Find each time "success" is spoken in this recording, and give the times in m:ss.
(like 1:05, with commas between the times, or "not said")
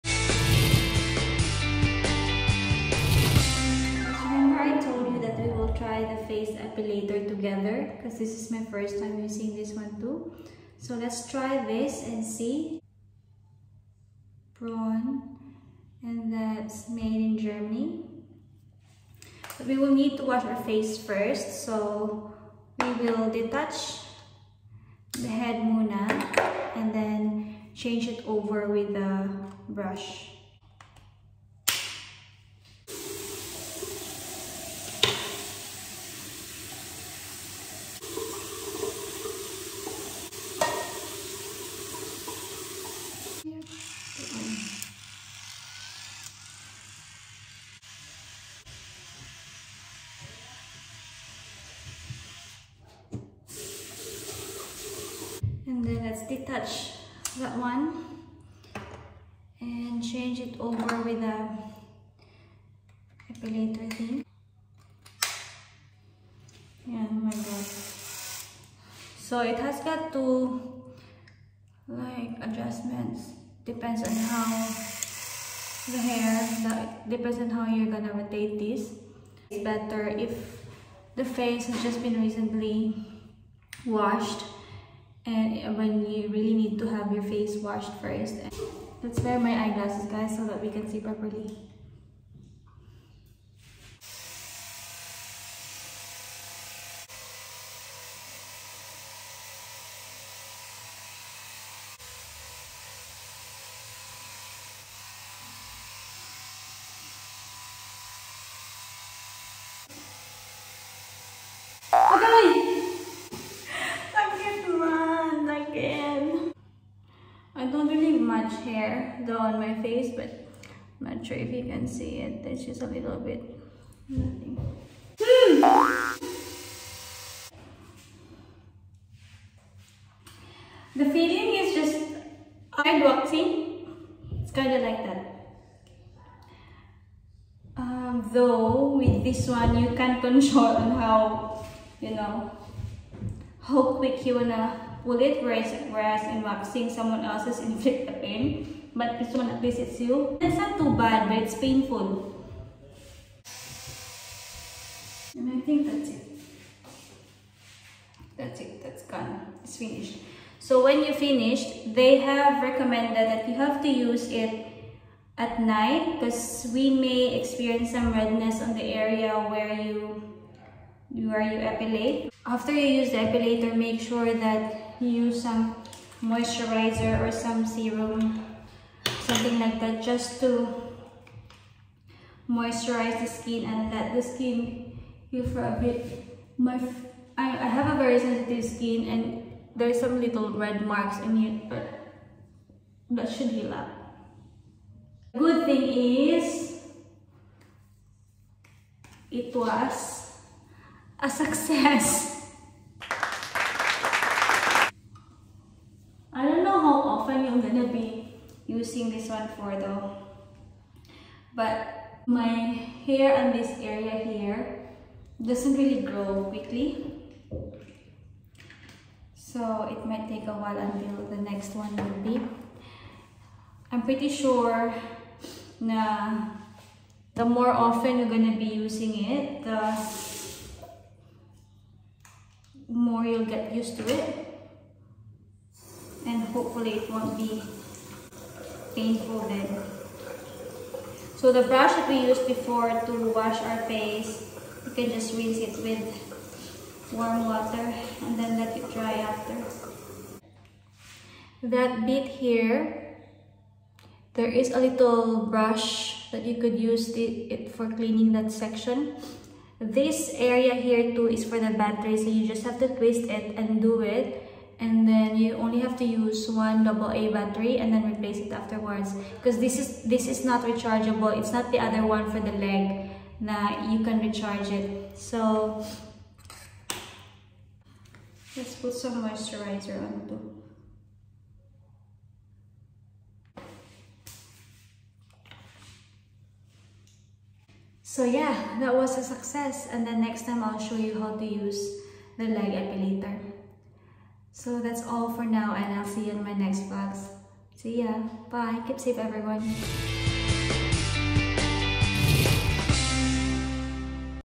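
3:21, 4:49.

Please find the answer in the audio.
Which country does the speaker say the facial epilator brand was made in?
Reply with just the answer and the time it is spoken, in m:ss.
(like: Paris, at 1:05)
Germany, at 0:17.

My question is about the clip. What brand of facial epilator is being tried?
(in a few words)
Braun.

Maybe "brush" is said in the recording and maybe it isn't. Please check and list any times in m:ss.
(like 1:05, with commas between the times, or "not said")
0:29, 4:01, 4:15.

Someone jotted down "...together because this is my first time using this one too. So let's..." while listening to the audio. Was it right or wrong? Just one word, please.
right.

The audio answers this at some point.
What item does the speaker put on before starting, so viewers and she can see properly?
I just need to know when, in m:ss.
1:29.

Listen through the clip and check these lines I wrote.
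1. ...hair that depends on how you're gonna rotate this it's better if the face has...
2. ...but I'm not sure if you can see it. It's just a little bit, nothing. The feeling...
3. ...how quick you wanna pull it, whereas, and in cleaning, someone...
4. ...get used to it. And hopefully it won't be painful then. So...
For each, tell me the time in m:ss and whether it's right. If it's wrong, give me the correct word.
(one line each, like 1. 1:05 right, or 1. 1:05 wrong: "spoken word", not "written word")
1. 1:16 right
2. 2:00 right
3. 2:23 wrong: "waxing", not "cleaning"
4. 3:53 right.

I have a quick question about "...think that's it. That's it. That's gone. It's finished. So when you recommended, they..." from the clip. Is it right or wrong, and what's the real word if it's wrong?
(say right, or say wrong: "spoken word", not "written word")
wrong: "finished", not "recommended".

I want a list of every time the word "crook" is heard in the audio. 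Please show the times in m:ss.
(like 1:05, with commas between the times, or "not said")
not said.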